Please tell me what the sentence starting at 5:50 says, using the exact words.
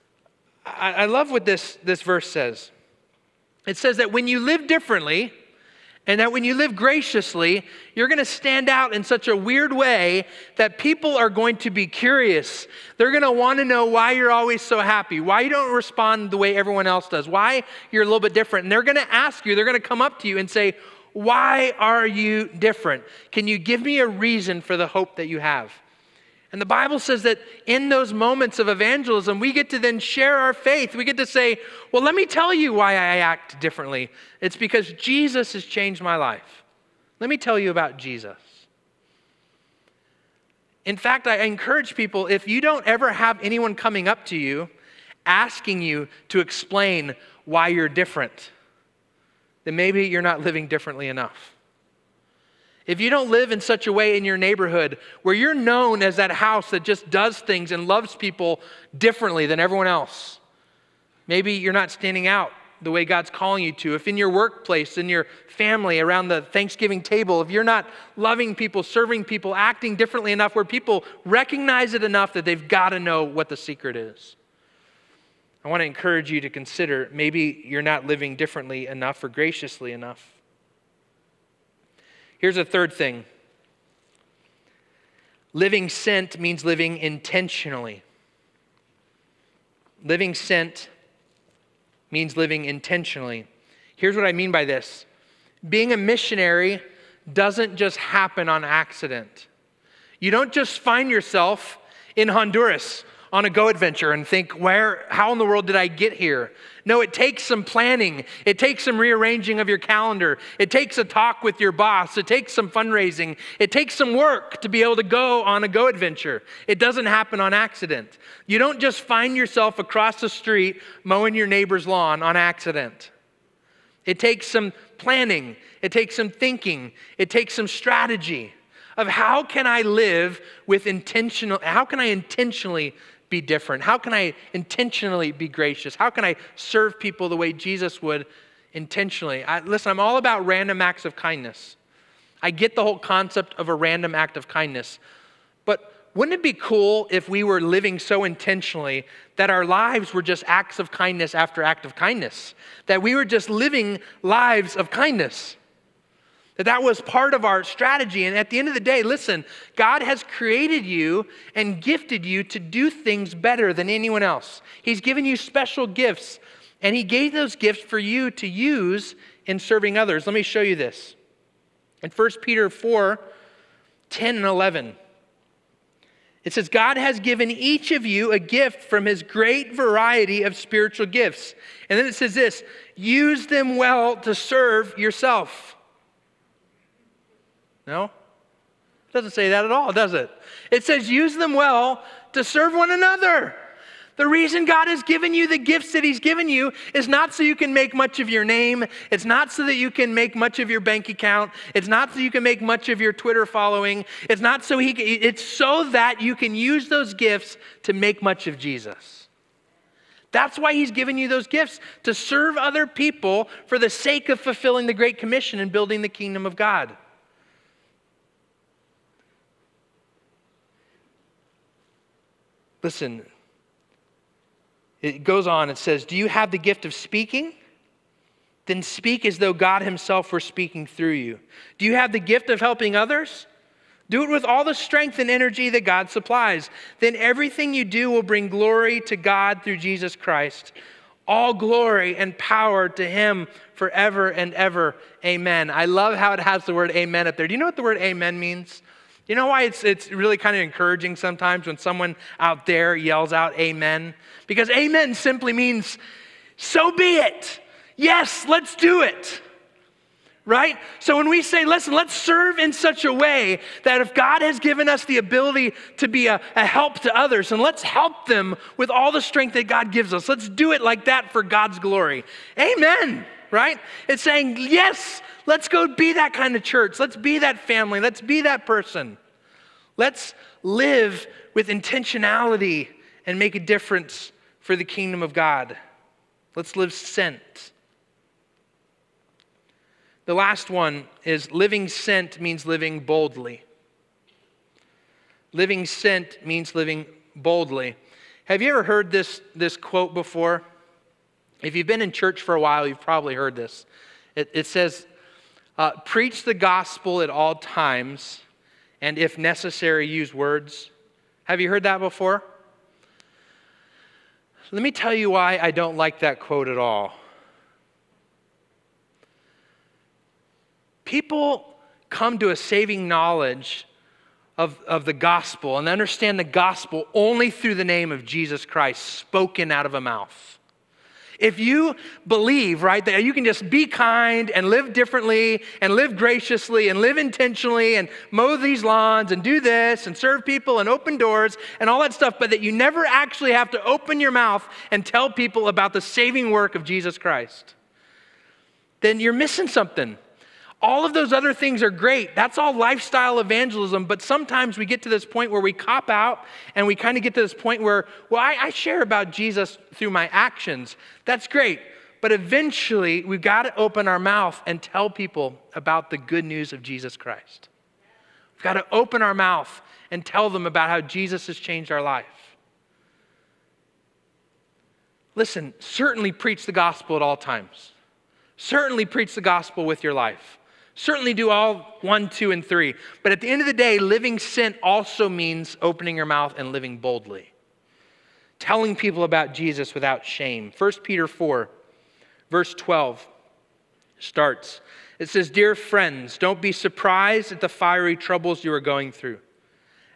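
All of those other things are great.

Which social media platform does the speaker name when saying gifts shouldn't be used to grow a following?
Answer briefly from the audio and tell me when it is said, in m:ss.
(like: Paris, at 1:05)
Twitter, at 3:23.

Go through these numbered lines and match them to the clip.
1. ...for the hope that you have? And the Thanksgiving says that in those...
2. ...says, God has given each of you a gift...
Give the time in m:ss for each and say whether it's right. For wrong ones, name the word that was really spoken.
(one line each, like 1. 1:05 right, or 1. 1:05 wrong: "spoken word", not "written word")
1. 0:24 wrong: "Bible", not "Thanksgiving"
2. 2:56 right.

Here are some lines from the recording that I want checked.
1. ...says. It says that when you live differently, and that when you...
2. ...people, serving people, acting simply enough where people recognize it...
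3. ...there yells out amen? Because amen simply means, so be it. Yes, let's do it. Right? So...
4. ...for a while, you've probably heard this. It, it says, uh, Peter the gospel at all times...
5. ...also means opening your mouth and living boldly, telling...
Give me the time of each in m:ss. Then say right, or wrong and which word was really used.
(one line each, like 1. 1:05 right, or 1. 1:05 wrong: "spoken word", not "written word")
1. 0:02 right
2. 1:08 wrong: "differently", not "simply"
3. 4:12 right
4. 5:02 wrong: "Preach", not "Peter"
5. 6:24 right.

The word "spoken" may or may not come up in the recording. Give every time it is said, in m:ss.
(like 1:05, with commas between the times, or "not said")
5:29.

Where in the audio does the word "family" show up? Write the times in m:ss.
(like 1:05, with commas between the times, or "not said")
1:05, 4:37.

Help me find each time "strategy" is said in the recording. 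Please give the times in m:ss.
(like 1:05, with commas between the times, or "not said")
2:07, 2:37.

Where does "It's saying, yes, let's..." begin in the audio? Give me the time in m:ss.
4:34.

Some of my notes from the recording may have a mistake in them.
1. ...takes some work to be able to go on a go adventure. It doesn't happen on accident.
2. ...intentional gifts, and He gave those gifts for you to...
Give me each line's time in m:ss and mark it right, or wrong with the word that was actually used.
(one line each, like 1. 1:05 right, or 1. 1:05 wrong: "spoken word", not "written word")
1. 1:53 right
2. 2:45 wrong: "special", not "intentional".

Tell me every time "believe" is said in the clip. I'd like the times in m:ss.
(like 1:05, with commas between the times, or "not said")
5:32.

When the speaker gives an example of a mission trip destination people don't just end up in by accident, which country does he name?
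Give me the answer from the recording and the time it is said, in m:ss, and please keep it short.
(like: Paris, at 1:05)
Honduras, at 1:42.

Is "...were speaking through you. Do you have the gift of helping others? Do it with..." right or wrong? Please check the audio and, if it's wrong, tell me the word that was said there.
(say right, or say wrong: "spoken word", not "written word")
right.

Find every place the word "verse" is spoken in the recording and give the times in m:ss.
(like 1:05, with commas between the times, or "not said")
0:02, 6:32.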